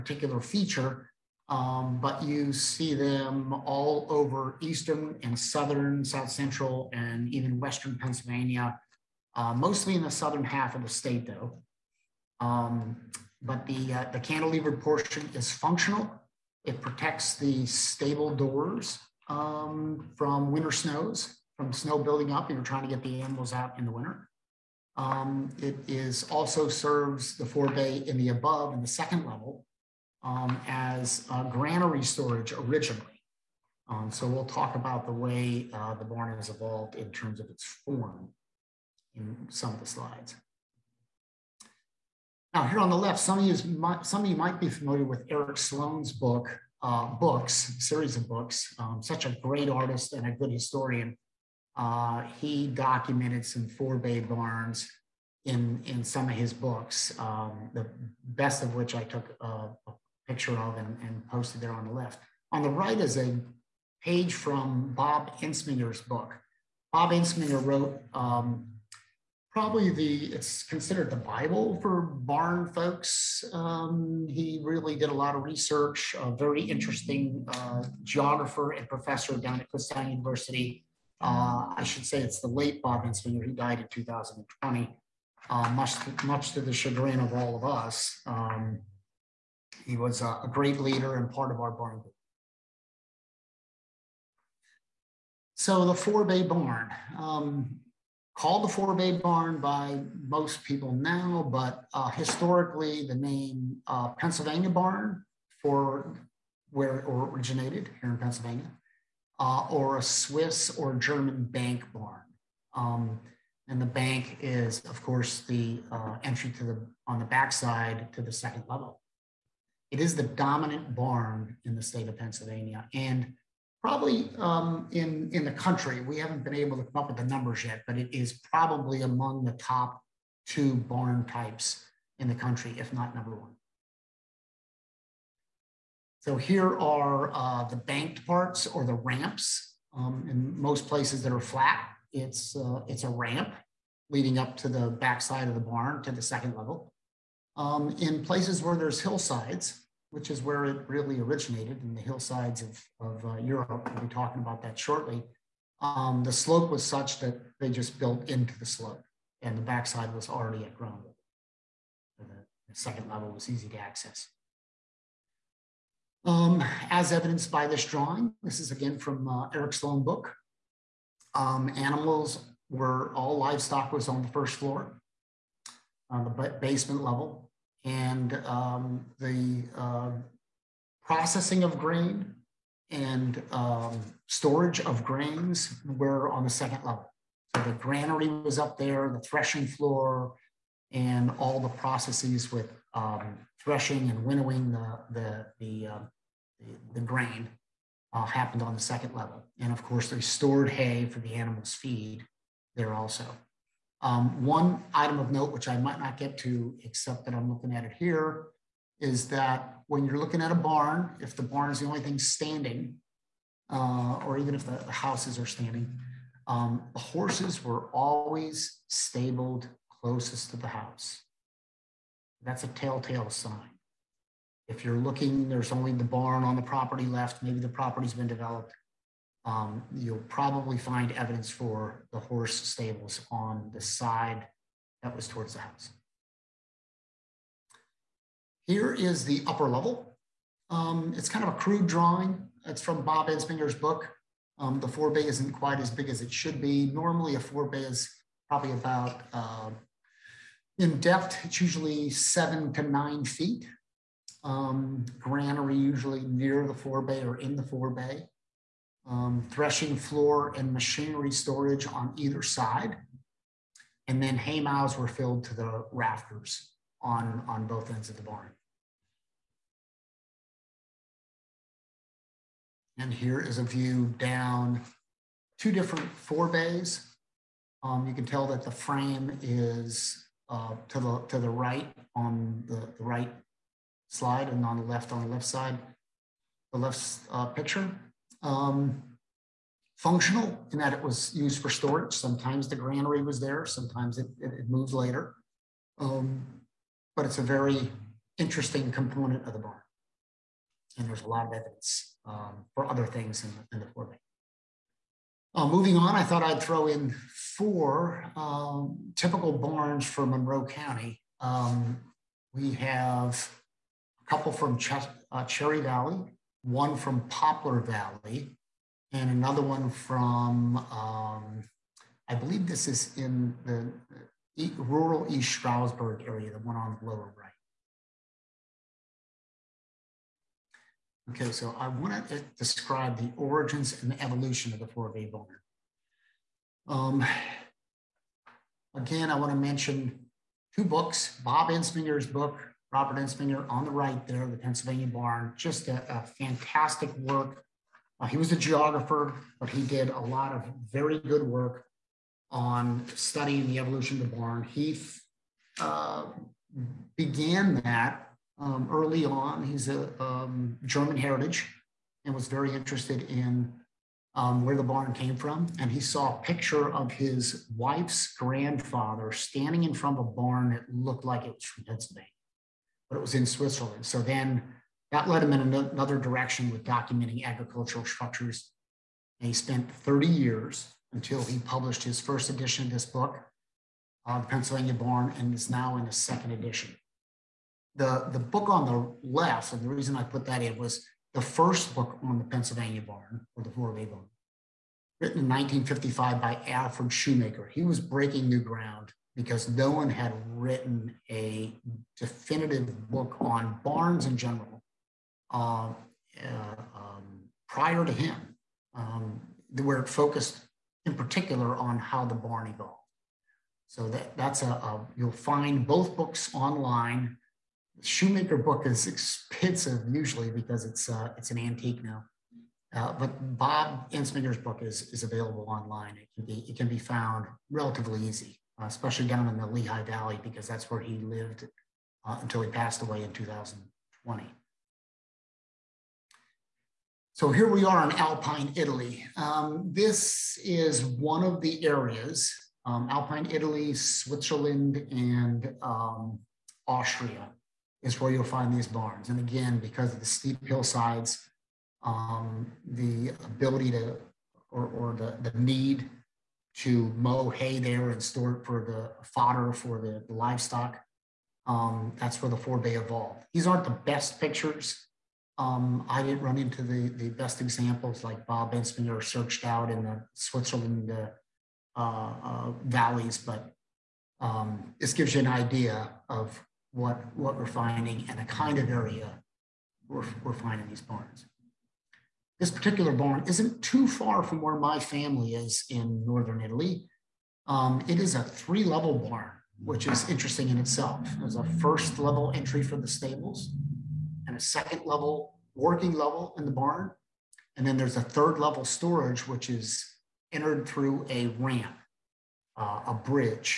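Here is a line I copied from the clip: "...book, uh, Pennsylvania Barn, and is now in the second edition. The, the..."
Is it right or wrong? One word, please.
right.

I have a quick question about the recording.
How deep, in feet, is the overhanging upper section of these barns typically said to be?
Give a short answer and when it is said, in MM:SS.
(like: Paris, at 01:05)
7 to 9 feet, at 04:12.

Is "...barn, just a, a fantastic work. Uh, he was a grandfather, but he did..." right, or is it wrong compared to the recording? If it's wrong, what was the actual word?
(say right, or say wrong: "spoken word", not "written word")
wrong: "geographer", not "grandfather".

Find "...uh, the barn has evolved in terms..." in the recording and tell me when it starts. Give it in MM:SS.
00:35.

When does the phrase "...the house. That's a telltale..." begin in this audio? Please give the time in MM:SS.
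03:40.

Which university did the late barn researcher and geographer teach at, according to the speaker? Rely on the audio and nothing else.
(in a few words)
Kutztown University.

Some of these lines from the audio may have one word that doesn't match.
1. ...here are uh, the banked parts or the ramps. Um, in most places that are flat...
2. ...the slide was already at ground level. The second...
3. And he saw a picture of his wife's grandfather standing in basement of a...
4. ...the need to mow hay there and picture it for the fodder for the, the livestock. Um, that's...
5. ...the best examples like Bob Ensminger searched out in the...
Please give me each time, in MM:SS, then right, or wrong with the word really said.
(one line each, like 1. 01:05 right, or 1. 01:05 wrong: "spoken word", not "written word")
1. 02:16 right
2. 02:39 wrong: "backside", not "slide"
3. 06:05 wrong: "front", not "basement"
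4. 07:35 wrong: "store", not "picture"
5. 07:47 right.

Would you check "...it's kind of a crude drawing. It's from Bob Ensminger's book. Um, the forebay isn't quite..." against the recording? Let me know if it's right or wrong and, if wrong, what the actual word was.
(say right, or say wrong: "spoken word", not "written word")
right.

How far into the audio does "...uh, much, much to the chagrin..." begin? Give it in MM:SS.
01:25.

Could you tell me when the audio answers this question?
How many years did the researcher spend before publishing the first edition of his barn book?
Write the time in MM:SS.
06:19.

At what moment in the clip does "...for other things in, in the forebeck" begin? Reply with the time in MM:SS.
05:02.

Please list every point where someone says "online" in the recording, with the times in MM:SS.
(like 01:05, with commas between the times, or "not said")
06:56, 07:05.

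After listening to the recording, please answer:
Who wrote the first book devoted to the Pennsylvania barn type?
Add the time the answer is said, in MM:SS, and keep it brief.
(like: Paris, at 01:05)
Alfred Shoemaker, at 06:36.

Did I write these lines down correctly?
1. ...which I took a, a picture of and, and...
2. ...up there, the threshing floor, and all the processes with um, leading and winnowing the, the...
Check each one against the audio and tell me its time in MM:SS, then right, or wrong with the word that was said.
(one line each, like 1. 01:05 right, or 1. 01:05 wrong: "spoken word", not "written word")
1. 00:58 right
2. 03:08 wrong: "threshing", not "leading".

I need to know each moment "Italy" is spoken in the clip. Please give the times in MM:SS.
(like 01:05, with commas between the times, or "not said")
07:18, 07:23, 08:06.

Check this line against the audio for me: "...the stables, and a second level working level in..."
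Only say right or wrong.
right.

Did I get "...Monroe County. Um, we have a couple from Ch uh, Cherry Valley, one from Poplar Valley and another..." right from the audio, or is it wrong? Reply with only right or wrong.
right.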